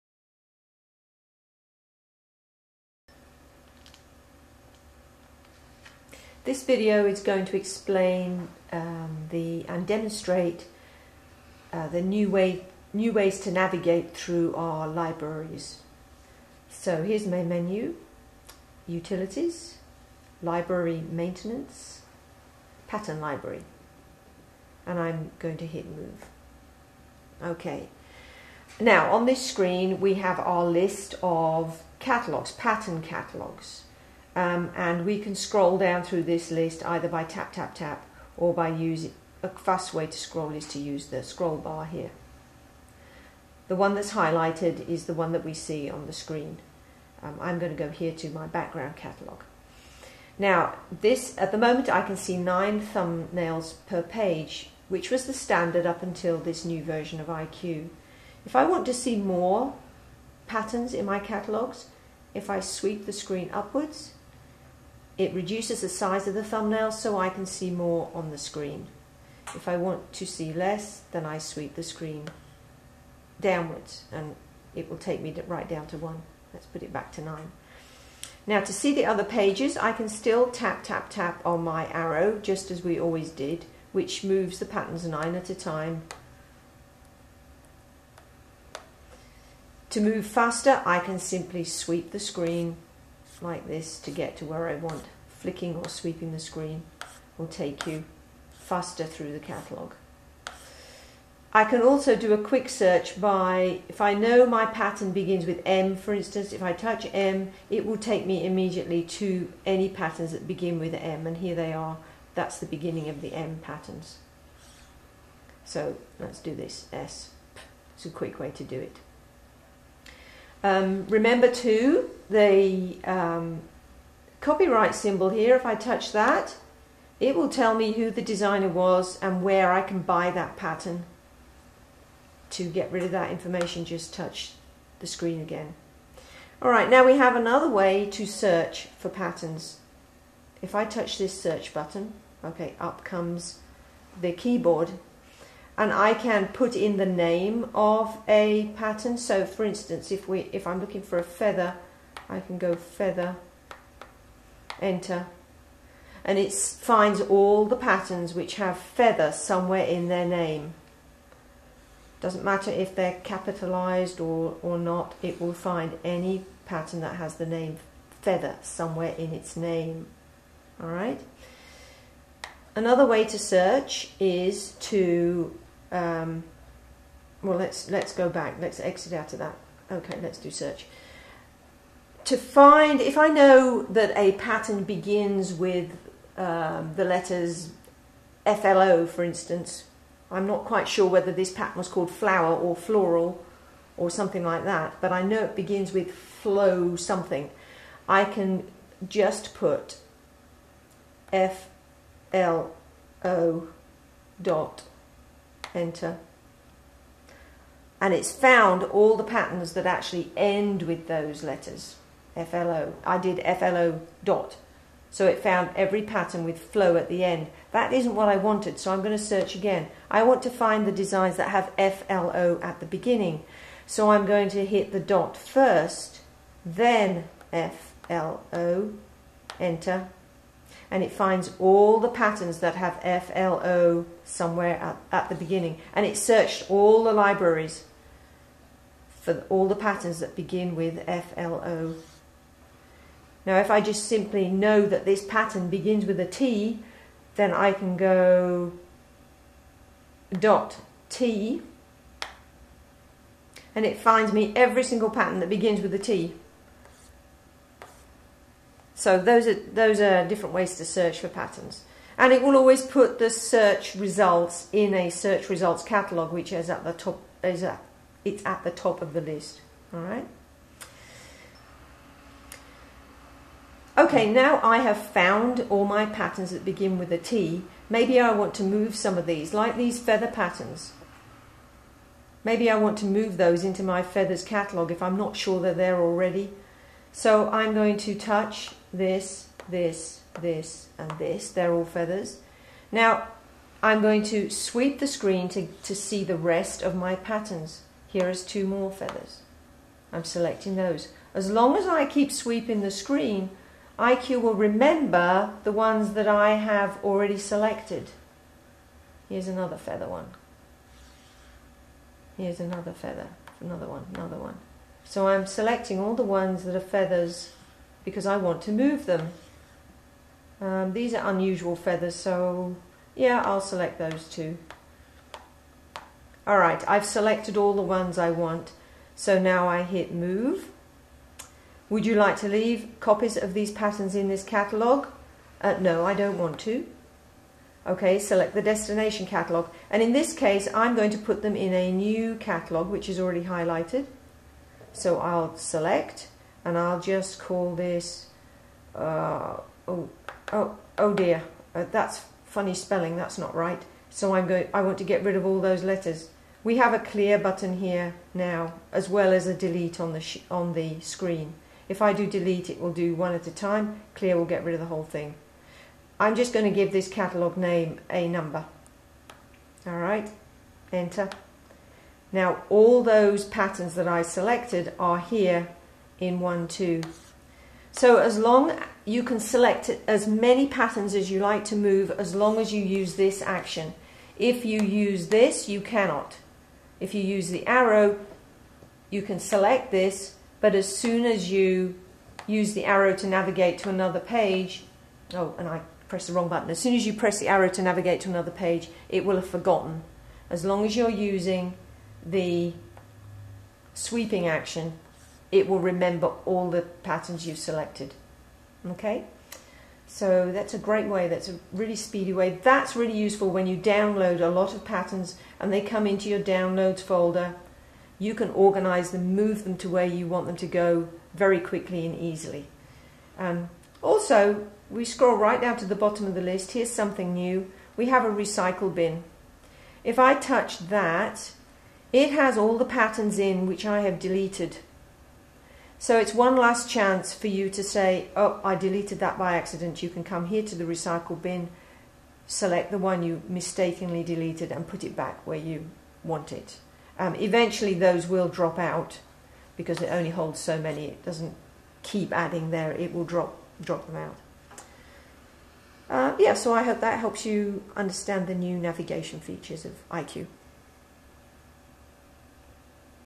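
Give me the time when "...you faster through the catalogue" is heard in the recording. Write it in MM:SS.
01:37.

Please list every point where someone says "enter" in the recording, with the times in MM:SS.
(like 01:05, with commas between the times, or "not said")
02:34, 03:25, 03:49, 06:10.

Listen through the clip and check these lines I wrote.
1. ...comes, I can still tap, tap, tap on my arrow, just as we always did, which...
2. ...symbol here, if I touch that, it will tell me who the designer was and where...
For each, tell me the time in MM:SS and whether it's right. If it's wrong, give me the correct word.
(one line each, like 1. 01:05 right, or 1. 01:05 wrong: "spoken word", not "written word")
1. 01:19 wrong: "pages", not "comes"
2. 02:04 right.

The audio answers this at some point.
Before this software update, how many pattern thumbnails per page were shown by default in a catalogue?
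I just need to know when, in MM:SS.
00:52.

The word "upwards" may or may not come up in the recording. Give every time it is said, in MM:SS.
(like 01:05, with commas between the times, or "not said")
01:03.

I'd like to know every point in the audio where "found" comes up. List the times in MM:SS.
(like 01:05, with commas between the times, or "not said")
03:28, 03:35, 04:34.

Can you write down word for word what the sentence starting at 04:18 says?
So those are, those are different ways to search for patterns.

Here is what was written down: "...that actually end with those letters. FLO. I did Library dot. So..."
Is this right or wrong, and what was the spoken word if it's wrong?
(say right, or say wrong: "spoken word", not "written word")
wrong: "FLO", not "Library".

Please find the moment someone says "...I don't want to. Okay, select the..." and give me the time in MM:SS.
05:36.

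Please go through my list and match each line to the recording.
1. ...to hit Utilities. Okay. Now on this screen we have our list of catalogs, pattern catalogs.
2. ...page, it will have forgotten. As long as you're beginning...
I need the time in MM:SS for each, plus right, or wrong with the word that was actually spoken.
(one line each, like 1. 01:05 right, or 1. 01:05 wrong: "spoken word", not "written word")
1. 00:25 wrong: "Move", not "Utilities"
2. 06:38 wrong: "using", not "beginning".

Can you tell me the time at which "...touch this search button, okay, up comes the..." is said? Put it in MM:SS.
02:20.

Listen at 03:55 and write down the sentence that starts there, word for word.
And it searched all the libraries for all the patterns that begin with FLO.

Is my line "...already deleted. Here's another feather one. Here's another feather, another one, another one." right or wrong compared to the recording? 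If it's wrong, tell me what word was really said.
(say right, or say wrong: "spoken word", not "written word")
wrong: "selected", not "deleted".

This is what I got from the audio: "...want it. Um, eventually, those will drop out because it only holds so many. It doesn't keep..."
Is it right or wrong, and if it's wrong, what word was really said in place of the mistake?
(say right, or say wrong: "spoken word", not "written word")
right.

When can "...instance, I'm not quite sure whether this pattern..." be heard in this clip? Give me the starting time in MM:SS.
03:09.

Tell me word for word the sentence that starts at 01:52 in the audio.
That's the beginning of the M patterns.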